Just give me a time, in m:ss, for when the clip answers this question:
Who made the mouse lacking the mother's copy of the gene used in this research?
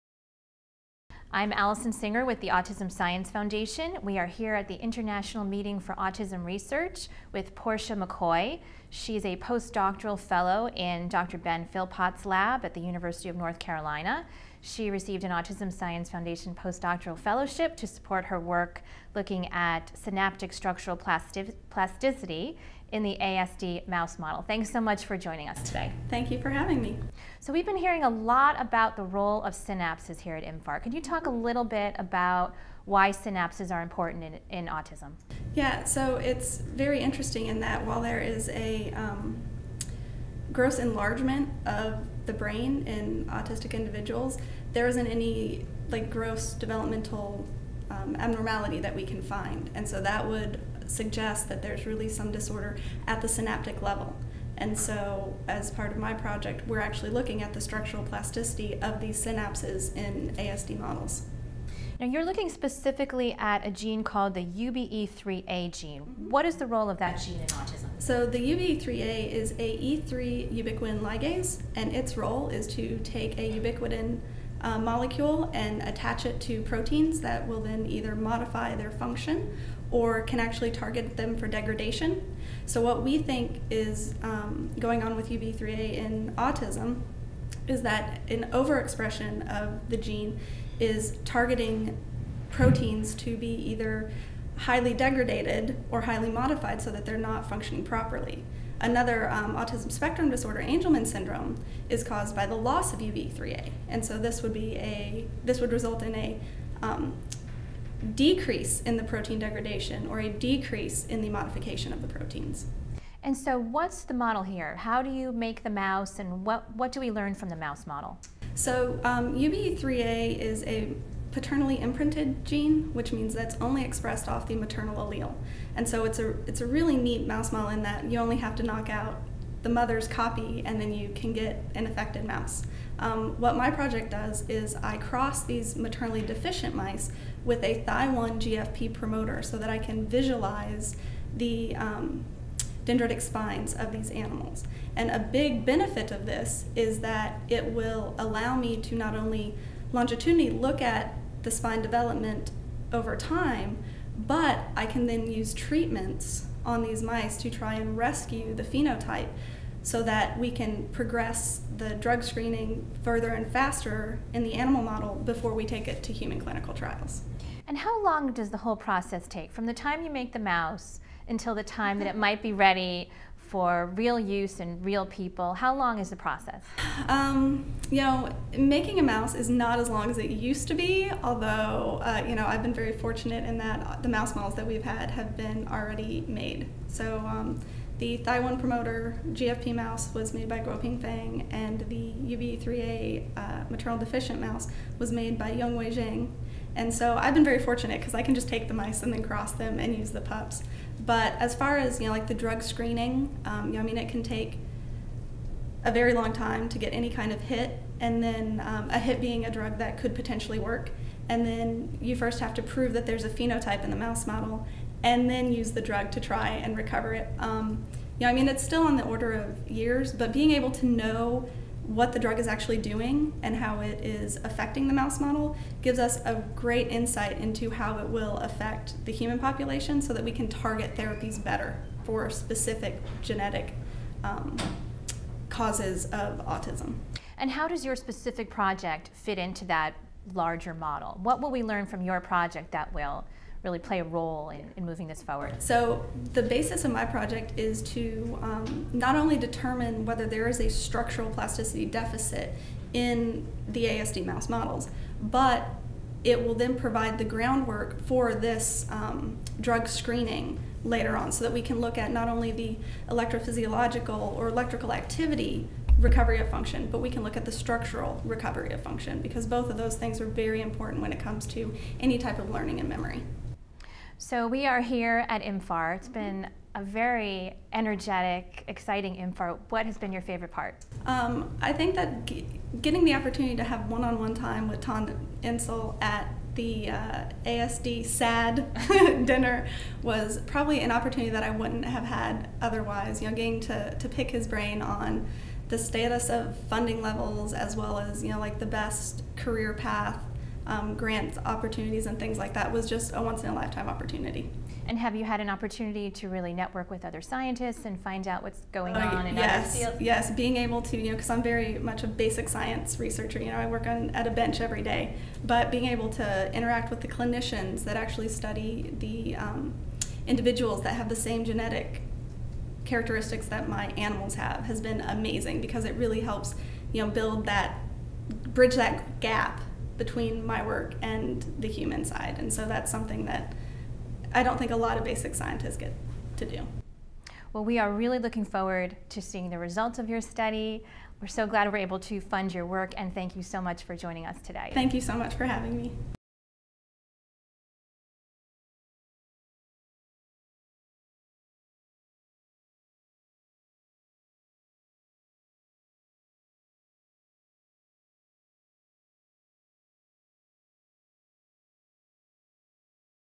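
3:15.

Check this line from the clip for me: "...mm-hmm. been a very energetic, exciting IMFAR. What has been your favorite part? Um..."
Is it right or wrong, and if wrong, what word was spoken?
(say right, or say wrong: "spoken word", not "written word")
right.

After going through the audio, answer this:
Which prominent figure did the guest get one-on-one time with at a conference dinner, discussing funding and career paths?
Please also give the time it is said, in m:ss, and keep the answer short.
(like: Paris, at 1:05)
Tom Insel, at 4:44.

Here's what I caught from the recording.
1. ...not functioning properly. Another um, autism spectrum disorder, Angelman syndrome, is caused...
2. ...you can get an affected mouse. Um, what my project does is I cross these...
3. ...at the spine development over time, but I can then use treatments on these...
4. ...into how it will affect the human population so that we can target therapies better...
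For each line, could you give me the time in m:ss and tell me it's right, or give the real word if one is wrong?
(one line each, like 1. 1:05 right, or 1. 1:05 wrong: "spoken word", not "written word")
1. 1:37 right
2. 2:10 right
3. 2:30 right
4. 3:47 right.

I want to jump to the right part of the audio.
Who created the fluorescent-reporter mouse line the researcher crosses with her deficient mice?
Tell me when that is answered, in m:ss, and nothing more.
3:10.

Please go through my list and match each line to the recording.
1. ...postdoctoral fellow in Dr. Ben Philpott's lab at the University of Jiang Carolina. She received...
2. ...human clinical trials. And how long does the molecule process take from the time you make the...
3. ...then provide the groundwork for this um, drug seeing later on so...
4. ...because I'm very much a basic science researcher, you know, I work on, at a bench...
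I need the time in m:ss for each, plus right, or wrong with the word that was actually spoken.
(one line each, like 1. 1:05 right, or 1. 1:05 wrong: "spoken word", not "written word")
1. 0:09 wrong: "North", not "Jiang"
2. 2:46 wrong: "whole", not "molecule"
3. 4:16 wrong: "screening", not "seeing"
4. 5:11 right.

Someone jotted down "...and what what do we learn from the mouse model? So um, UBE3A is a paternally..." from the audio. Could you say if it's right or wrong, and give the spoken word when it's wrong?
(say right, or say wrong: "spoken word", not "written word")
right.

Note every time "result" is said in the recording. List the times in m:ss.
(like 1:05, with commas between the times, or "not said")
1:45, 5:39.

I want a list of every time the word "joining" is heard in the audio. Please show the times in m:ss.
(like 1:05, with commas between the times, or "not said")
0:25, 5:43.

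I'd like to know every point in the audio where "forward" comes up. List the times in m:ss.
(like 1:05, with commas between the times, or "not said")
4:05, 5:38.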